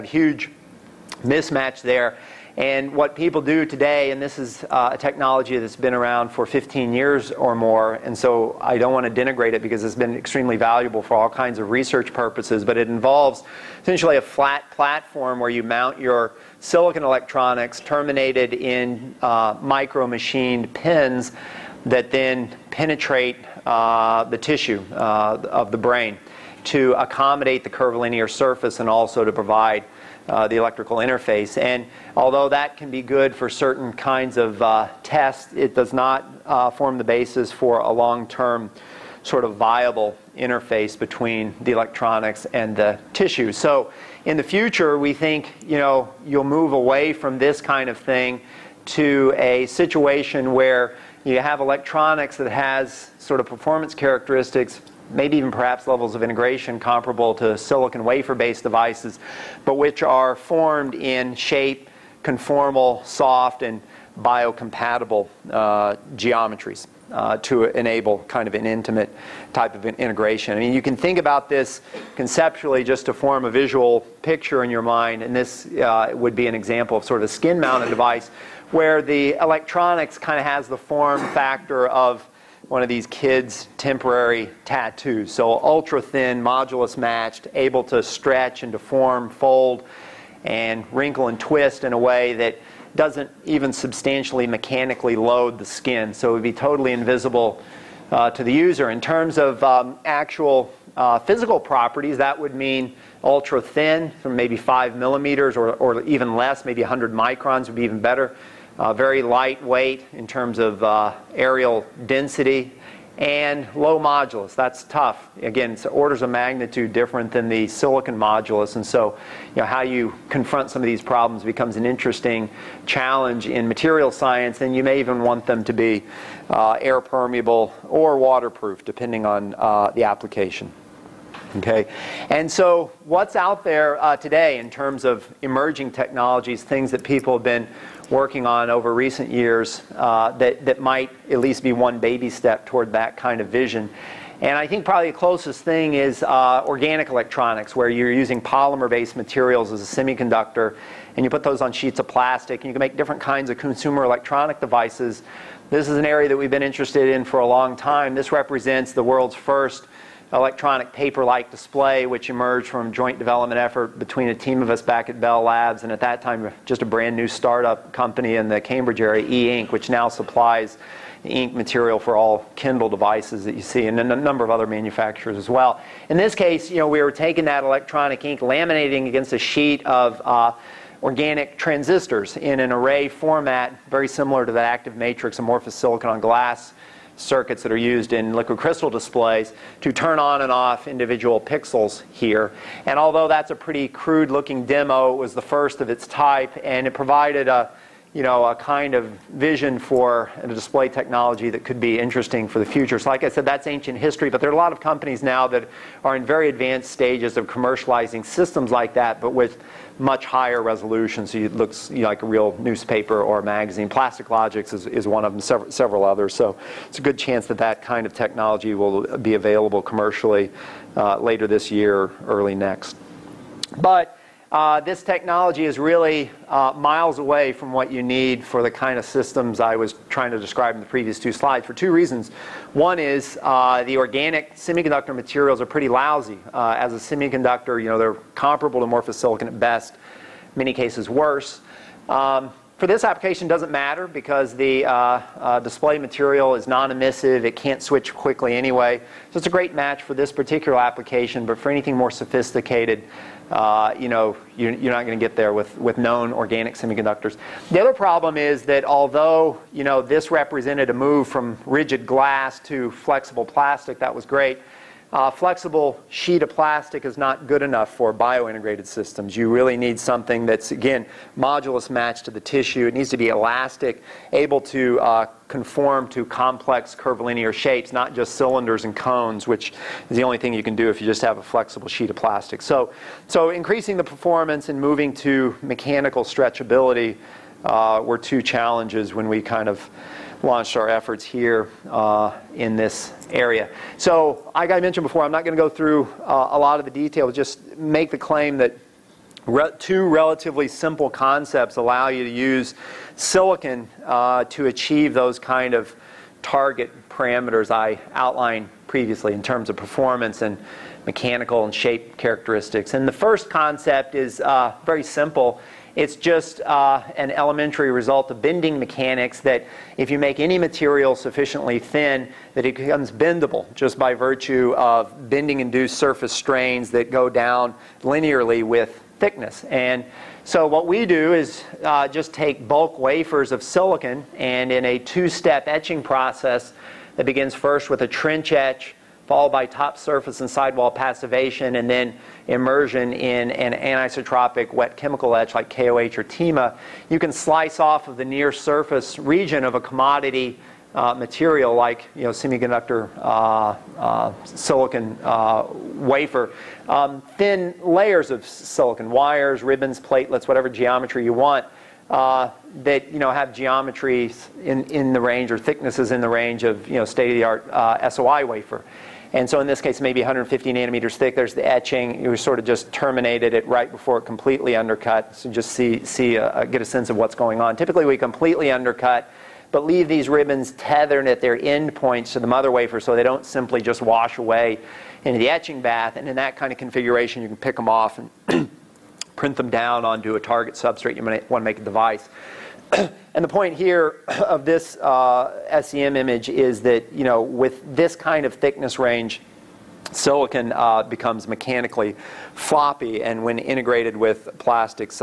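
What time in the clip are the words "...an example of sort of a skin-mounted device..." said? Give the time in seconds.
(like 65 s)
76 s.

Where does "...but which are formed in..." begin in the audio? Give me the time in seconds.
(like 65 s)
59 s.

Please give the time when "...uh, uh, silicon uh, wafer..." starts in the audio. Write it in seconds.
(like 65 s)
353 s.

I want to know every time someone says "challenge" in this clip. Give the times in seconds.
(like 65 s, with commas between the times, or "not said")
122 s, 288 s.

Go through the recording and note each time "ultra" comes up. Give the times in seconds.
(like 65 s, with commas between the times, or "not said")
85 s, 103 s.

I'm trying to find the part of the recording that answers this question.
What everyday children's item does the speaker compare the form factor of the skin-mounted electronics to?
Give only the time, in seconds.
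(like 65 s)
83 s.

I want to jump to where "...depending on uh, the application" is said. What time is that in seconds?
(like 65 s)
128 s.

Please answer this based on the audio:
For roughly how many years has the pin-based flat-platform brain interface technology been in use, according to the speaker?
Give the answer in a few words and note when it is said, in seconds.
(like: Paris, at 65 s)
15 years, at 6 s.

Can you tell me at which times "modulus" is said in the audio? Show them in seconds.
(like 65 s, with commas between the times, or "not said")
86 s, 113 s, 118 s, 271 s.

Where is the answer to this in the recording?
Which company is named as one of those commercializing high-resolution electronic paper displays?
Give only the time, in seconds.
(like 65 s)
213 s.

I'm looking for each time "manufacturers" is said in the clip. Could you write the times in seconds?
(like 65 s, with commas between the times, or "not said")
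174 s.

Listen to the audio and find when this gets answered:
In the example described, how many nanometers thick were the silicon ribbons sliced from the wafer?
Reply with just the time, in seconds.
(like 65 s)
370 s.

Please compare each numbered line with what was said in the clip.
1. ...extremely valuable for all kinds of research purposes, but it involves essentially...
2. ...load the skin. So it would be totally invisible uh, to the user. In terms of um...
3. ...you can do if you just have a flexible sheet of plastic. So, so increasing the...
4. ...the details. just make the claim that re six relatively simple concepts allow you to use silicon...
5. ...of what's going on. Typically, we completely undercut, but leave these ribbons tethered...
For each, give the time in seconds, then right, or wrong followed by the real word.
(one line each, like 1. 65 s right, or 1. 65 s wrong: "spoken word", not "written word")
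1. 10 s right
2. 95 s right
3. 280 s right
4. 296 s wrong: "two", not "six"
5. 377 s right.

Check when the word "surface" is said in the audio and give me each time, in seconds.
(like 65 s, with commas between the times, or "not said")
28 s, 325 s, 339 s, 348 s.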